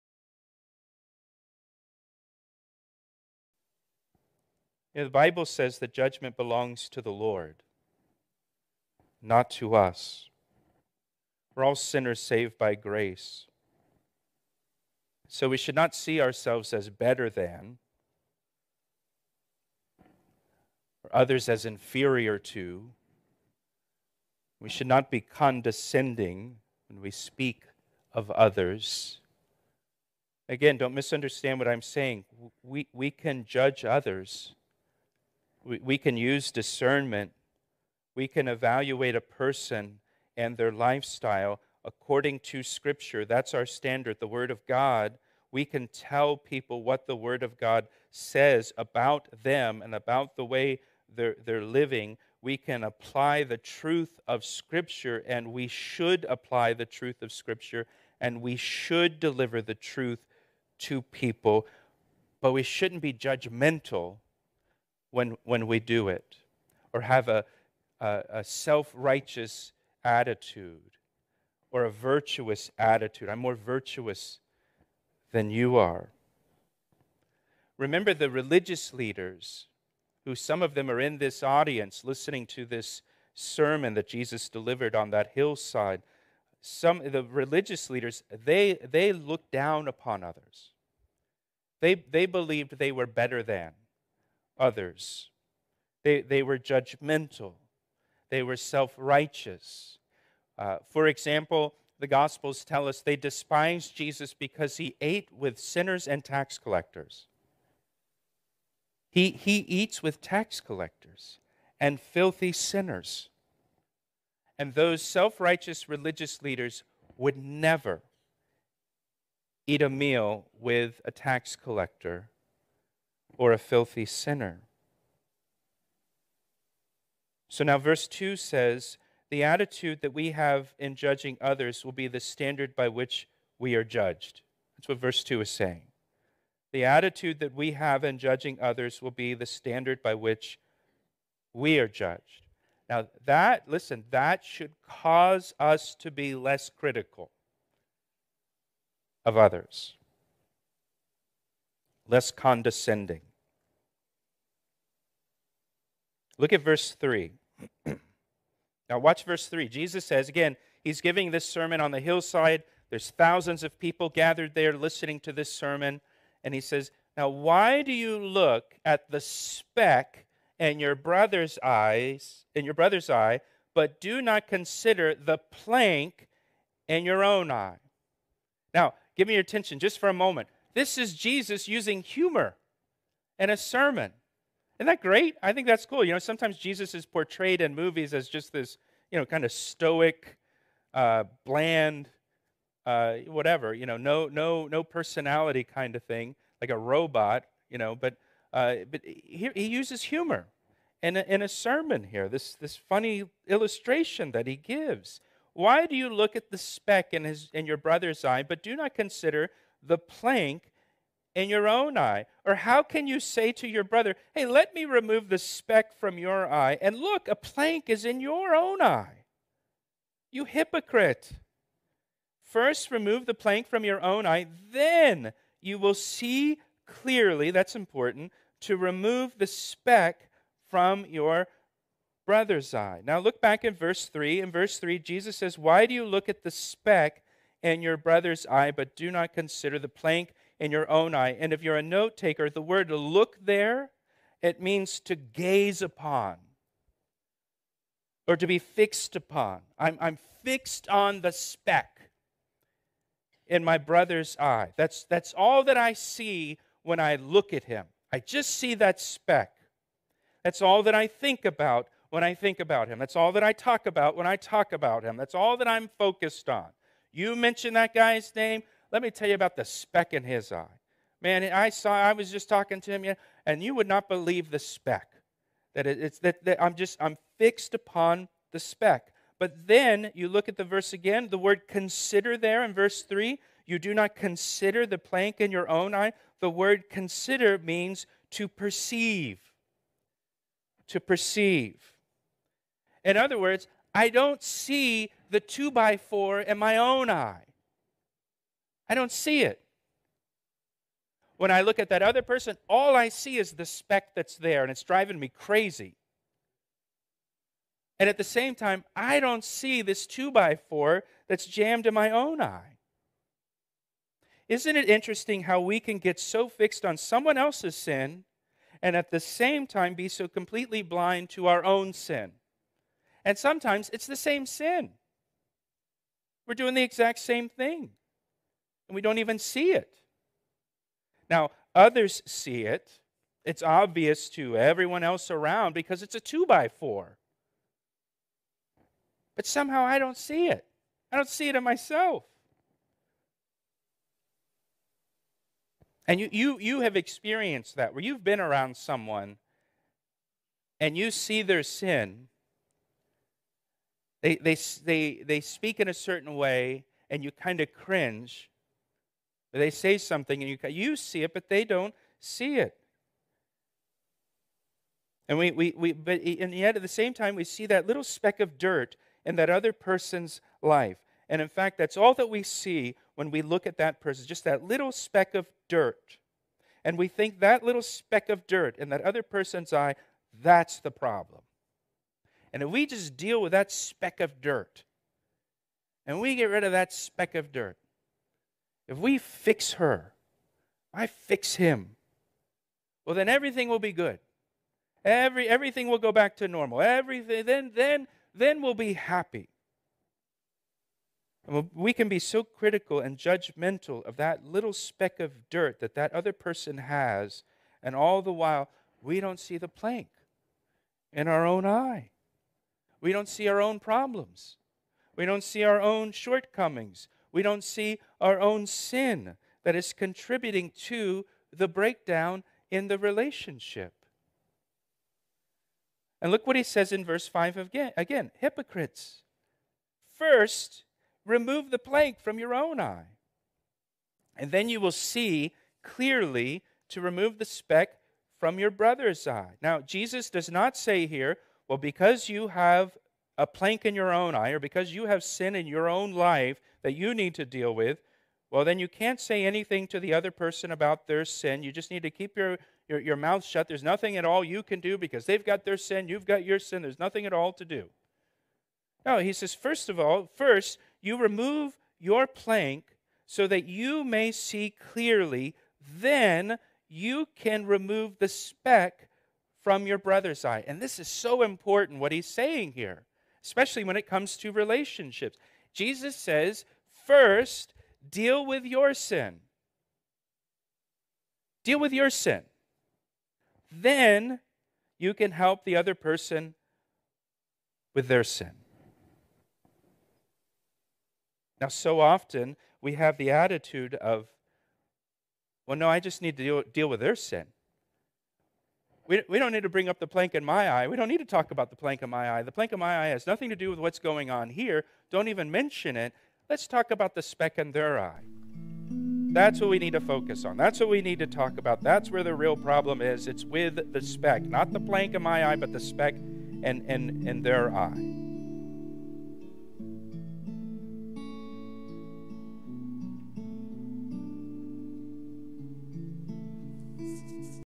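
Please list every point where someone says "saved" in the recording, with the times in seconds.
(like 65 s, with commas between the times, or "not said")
12 s.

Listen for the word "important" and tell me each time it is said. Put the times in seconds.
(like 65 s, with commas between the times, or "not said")
227 s, 471 s.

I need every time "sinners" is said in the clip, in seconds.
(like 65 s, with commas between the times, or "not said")
11 s, 105 s, 112 s, 124 s.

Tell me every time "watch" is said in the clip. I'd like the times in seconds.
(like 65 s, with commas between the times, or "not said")
158 s.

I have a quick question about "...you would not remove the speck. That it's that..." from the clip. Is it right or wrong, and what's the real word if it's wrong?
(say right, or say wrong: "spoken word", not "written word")
wrong: "believe", not "remove".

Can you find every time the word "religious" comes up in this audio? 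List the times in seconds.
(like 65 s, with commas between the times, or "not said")
78 s, 87 s, 115 s.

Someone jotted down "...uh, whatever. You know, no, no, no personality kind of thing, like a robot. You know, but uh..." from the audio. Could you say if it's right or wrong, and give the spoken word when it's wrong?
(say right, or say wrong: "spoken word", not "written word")
right.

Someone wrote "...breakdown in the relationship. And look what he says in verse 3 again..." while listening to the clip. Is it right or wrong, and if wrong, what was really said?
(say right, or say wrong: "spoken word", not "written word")
wrong: "5", not "3".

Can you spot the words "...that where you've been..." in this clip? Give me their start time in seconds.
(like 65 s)
347 s.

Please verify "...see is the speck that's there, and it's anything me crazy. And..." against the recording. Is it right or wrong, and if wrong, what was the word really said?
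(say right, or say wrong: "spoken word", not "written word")
wrong: "driving", not "anything".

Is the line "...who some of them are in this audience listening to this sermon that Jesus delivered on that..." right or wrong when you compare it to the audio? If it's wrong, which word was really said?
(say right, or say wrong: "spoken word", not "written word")
right.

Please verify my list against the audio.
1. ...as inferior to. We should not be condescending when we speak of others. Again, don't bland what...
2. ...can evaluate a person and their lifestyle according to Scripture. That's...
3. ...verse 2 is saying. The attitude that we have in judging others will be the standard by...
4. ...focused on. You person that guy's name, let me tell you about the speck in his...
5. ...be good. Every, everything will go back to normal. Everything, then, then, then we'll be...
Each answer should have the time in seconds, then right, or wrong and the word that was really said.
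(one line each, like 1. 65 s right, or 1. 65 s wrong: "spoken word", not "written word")
1. 21 s wrong: "misunderstand", not "bland"
2. 38 s right
3. 134 s right
4. 265 s wrong: "mention", not "person"
5. 393 s right.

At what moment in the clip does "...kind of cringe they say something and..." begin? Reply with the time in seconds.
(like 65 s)
357 s.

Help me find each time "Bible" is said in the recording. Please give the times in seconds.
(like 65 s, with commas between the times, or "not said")
5 s.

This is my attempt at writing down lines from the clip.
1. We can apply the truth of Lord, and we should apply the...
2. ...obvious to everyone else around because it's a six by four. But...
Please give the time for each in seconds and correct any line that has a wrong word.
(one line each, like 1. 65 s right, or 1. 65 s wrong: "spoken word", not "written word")
1. 52 s wrong: "Scripture", not "Lord"
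2. 333 s wrong: "two", not "six".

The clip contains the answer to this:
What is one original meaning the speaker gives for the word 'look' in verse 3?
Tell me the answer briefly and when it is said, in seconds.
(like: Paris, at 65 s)
to gaze upon, at 245 s.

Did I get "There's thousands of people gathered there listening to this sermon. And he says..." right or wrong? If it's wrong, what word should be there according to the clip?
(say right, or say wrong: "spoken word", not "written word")
right.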